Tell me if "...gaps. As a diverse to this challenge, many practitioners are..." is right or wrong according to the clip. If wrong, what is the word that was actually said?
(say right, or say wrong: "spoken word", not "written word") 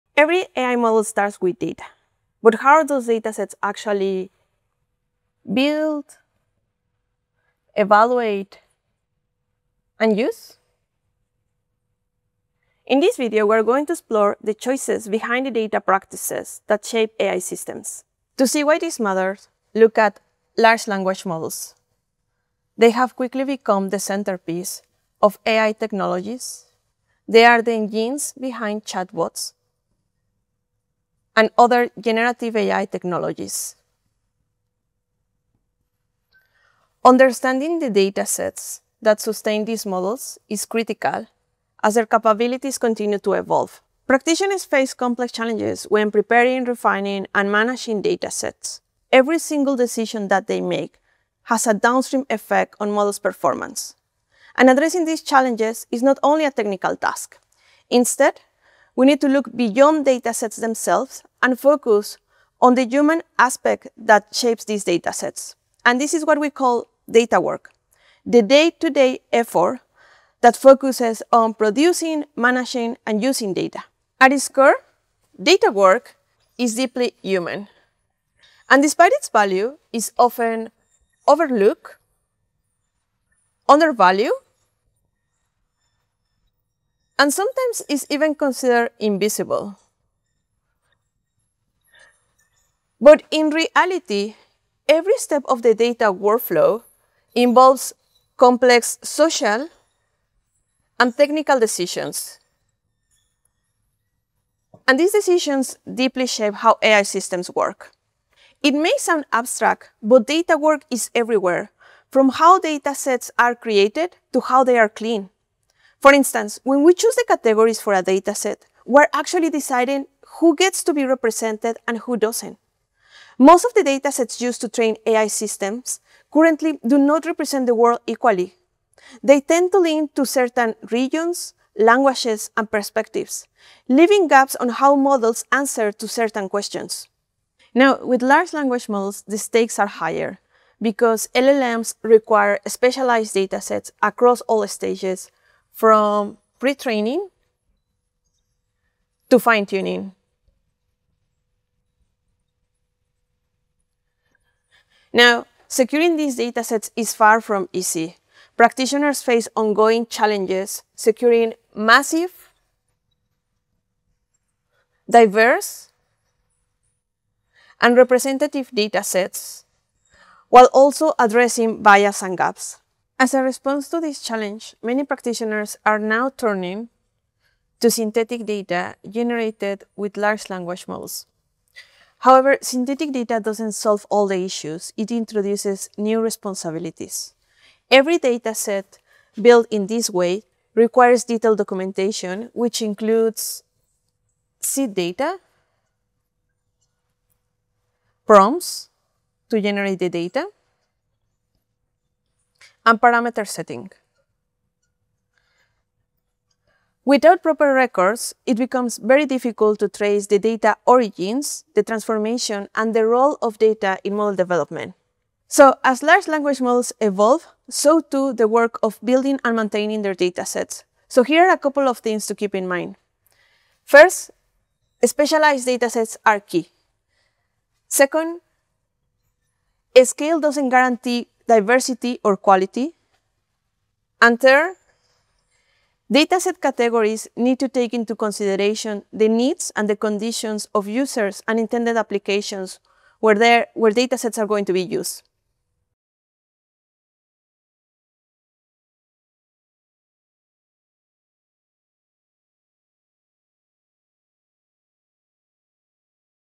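wrong: "response", not "diverse".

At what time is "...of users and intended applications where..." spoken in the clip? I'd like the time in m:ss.
4:00.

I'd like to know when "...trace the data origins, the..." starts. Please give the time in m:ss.
3:29.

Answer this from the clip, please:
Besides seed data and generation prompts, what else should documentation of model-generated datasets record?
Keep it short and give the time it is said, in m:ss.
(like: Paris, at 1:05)
parameter setting, at 3:23.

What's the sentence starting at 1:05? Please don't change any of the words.
And this is what we call data work, the day-to-day -day effort that focuses on producing, managing, and using data.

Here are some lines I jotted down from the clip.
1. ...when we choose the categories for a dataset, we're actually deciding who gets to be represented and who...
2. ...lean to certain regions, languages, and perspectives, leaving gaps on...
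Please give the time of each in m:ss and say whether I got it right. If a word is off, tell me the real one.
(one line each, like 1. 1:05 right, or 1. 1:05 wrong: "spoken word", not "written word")
1. 1:56 right
2. 2:09 right.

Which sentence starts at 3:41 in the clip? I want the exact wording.
So here are a couple of things to keep in mind.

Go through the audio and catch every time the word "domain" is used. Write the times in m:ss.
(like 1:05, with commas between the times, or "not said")
not said.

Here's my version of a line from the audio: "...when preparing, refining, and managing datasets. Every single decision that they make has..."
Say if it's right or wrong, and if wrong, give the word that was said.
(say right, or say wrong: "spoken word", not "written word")
right.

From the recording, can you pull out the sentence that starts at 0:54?
And addressing these challenges is not only a technical task.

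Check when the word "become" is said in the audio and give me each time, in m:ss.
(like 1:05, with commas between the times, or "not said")
0:23, 3:28.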